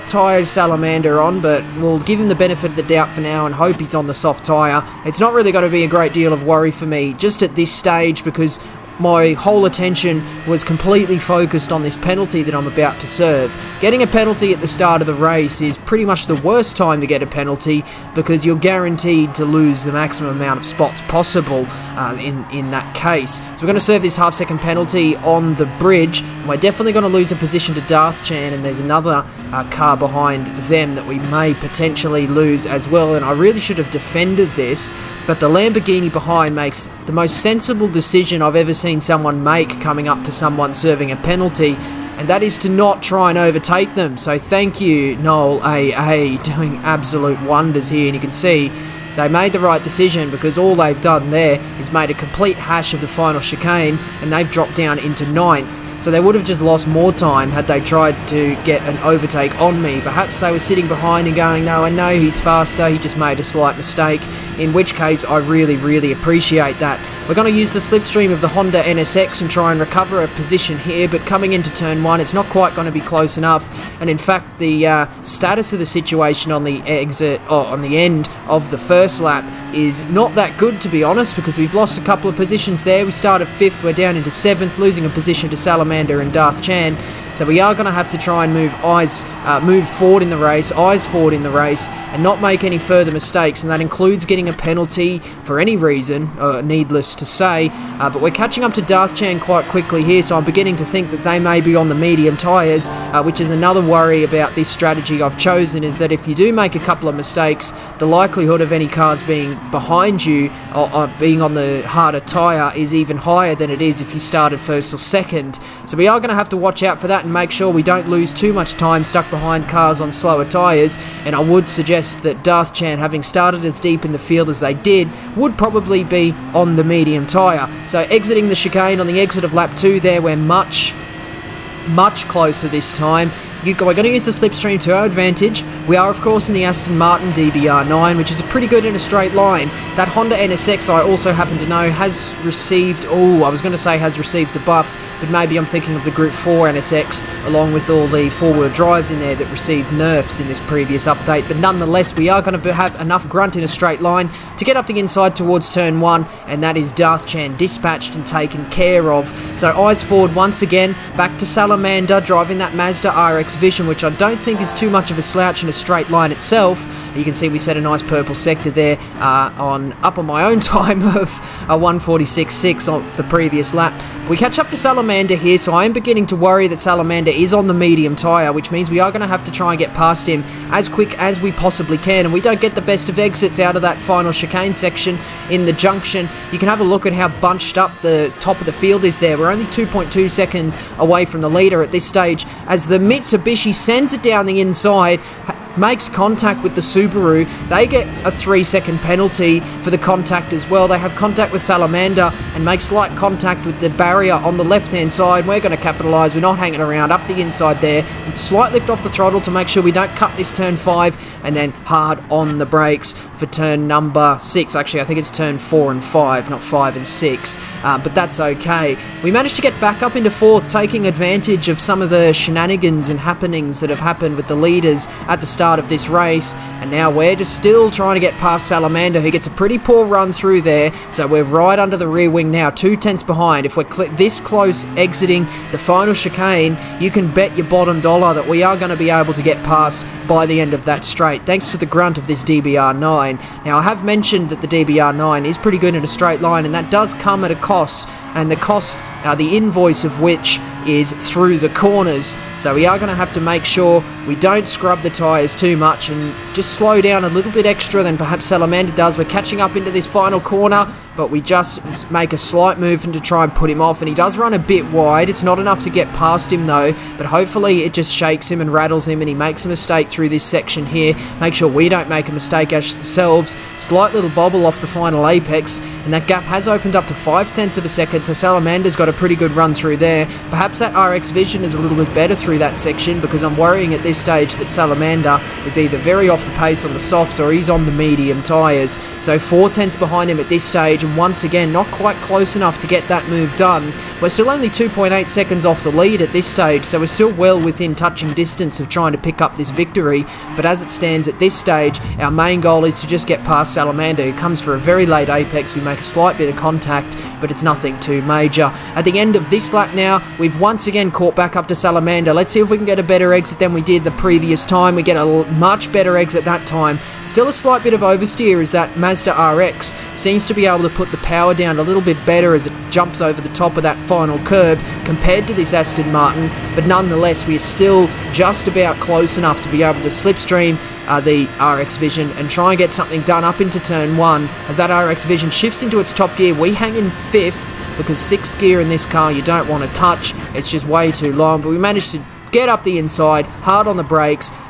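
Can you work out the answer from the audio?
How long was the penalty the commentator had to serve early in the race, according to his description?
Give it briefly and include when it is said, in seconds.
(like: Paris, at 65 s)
half second, at 24 s.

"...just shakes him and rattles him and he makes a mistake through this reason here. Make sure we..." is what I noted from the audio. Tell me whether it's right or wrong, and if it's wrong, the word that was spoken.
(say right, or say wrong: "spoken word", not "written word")
wrong: "section", not "reason".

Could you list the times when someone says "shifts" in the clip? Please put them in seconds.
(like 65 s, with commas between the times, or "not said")
335 s.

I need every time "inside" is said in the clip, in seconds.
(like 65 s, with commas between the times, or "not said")
154 s, 194 s, 207 s, 342 s.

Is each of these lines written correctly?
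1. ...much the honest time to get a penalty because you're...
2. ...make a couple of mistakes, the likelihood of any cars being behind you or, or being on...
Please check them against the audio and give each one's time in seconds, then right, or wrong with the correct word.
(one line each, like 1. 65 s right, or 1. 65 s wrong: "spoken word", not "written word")
1. 16 s wrong: "worst", not "honest"
2. 106 s right.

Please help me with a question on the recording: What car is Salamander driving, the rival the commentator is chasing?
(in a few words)
Mazda RX Vision.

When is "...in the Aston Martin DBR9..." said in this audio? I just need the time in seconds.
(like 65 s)
136 s.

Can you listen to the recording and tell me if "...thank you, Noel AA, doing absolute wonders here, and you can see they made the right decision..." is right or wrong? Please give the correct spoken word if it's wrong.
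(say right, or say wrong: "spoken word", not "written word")
right.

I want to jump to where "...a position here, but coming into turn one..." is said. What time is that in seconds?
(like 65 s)
70 s.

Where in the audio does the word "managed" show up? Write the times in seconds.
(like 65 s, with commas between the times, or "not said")
219 s, 341 s.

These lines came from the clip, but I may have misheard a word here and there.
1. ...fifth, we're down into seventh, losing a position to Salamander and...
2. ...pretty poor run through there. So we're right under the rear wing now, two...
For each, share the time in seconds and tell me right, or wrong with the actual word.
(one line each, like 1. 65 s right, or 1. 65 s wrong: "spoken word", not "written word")
1. 83 s right
2. 229 s right.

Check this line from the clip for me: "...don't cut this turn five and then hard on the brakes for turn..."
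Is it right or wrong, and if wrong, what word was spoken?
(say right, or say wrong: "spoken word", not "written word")
right.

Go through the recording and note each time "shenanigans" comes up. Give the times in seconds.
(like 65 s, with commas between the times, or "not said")
222 s.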